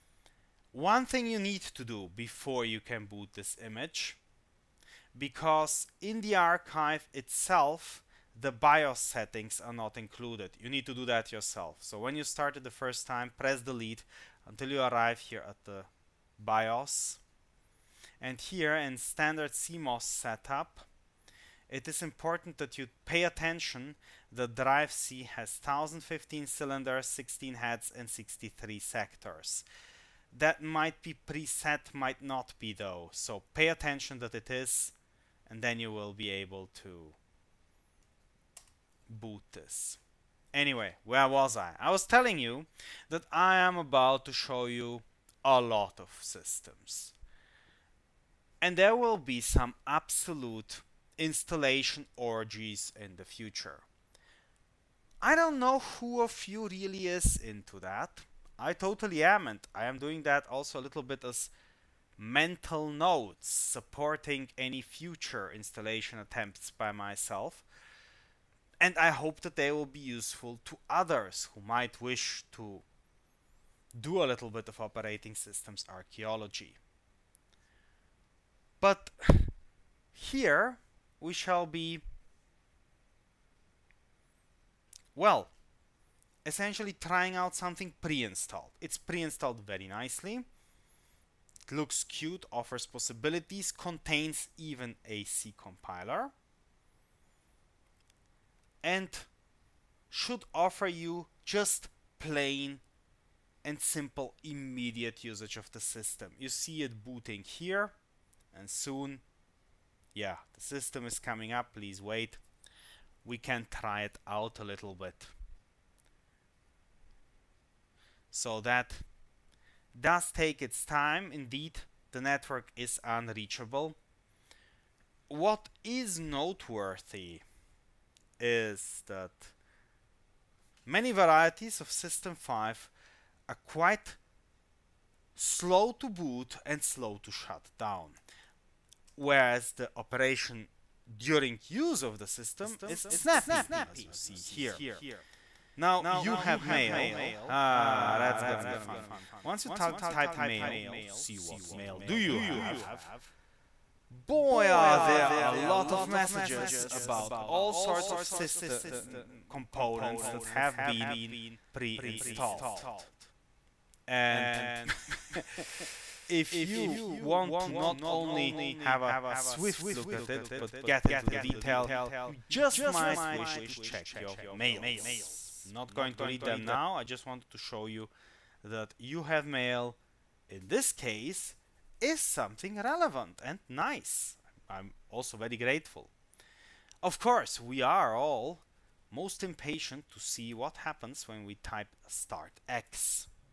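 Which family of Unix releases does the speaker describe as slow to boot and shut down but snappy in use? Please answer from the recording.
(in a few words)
System 5.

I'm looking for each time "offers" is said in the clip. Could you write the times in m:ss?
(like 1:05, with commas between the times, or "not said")
1:32, 1:40.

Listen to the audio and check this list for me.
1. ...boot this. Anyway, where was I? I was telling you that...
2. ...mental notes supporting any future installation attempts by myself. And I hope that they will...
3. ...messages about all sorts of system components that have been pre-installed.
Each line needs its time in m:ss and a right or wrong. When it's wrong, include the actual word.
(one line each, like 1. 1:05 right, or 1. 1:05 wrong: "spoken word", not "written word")
1. 0:39 right
2. 1:02 right
3. 2:36 right.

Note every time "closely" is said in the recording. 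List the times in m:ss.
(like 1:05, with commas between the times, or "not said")
not said.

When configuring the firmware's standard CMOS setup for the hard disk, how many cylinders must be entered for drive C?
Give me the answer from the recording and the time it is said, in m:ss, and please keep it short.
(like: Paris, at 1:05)
1015, at 0:25.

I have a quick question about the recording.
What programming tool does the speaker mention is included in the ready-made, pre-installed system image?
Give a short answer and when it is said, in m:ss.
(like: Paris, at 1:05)
C compiler, at 1:35.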